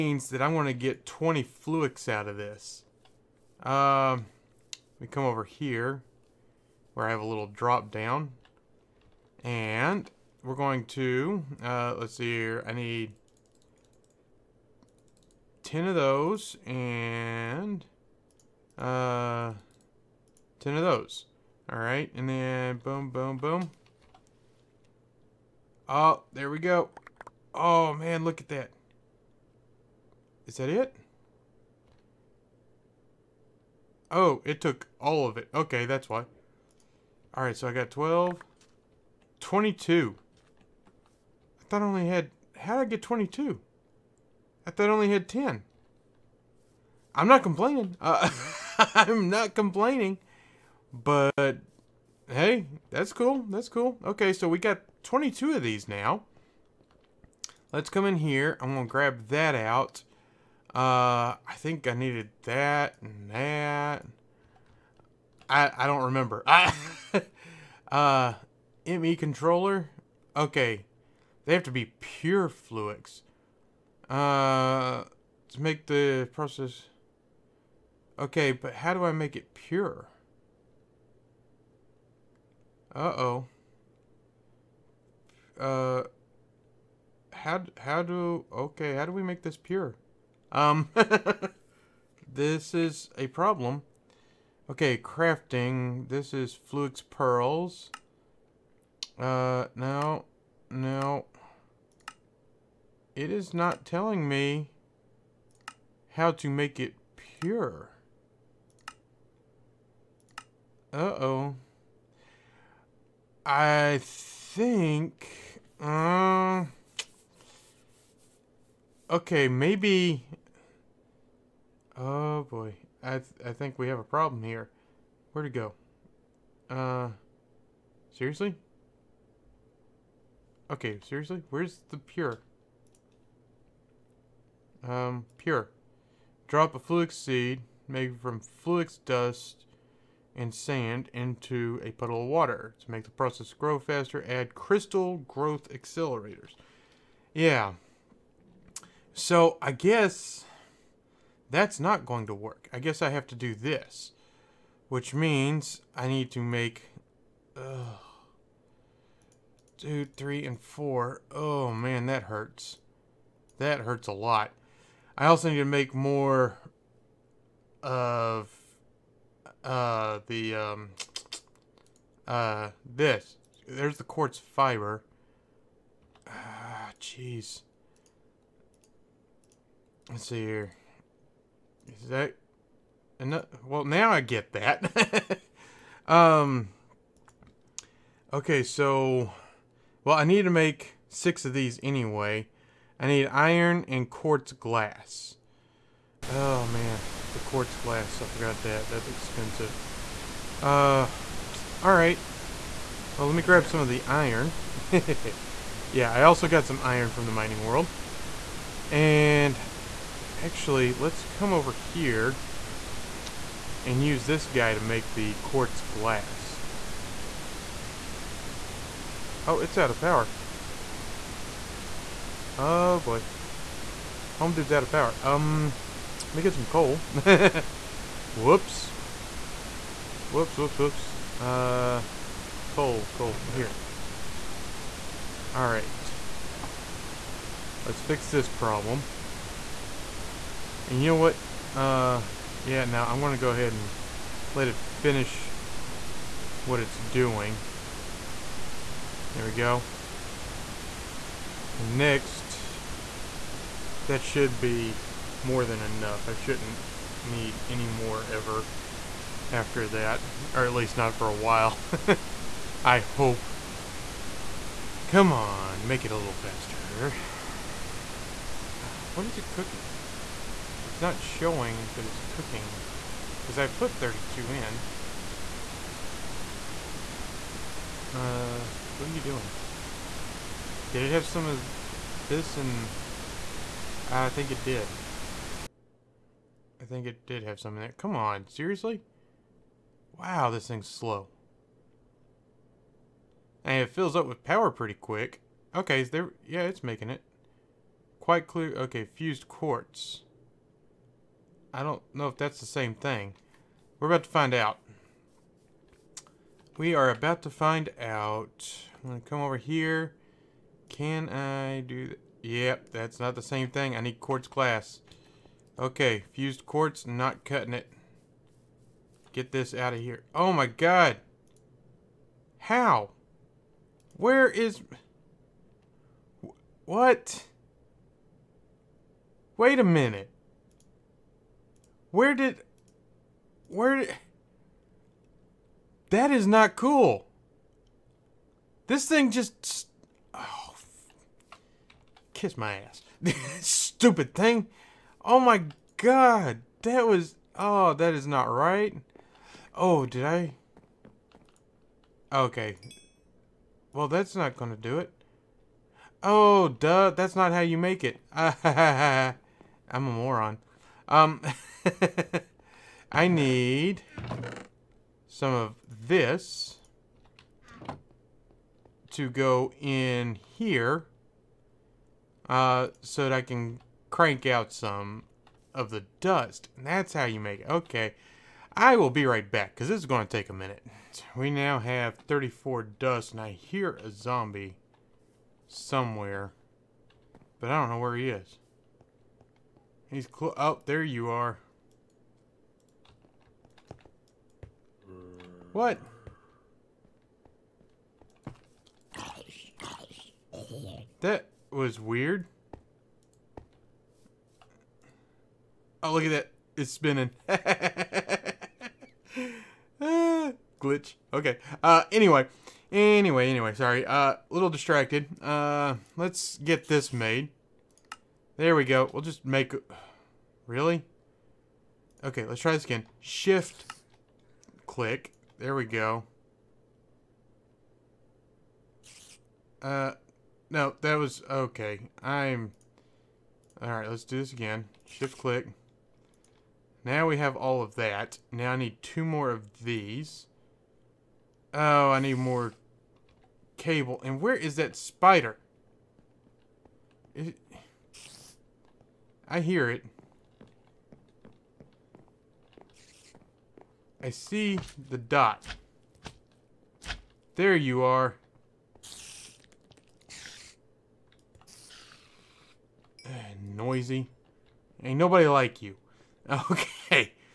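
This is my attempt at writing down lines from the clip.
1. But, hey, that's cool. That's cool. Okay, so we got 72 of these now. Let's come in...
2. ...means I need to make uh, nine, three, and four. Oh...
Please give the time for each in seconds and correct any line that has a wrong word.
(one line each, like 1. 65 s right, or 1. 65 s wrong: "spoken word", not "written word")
1. 50 s wrong: "22", not "72"
2. 155 s wrong: "two", not "nine".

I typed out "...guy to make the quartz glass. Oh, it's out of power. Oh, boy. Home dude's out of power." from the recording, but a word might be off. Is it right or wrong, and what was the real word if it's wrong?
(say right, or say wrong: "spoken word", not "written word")
right.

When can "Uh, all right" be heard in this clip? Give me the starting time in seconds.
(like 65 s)
200 s.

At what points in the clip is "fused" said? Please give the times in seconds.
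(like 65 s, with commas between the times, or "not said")
299 s, 316 s.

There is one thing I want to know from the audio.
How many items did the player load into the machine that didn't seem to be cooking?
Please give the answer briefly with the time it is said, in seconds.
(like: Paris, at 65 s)
32, at 273 s.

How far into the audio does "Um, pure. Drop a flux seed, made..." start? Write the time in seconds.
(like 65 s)
134 s.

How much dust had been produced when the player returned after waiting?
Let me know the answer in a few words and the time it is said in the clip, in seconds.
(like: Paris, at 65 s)
34, at 382 s.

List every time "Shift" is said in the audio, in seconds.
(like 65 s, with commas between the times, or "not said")
423 s, 435 s.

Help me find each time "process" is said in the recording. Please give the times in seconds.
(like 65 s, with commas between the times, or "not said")
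76 s, 143 s.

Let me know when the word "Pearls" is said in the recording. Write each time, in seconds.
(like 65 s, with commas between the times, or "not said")
97 s.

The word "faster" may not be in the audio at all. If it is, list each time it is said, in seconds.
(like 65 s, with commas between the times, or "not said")
143 s, 266 s.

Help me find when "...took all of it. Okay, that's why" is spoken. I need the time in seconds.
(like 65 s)
34 s.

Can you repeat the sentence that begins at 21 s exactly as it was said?
All right, and then boom, boom, boom.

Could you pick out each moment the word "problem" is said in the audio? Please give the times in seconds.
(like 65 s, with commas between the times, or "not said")
93 s, 124 s, 238 s.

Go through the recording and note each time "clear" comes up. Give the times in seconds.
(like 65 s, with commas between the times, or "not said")
298 s.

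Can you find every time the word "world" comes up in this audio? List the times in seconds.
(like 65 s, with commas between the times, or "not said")
207 s.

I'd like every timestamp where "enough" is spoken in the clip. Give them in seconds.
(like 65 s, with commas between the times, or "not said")
183 s, 255 s.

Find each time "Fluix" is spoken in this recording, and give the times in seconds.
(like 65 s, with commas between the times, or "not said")
1 s, 72 s.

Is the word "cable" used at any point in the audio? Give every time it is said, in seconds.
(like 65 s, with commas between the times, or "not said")
443 s.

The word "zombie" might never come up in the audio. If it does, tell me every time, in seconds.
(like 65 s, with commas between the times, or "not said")
384 s.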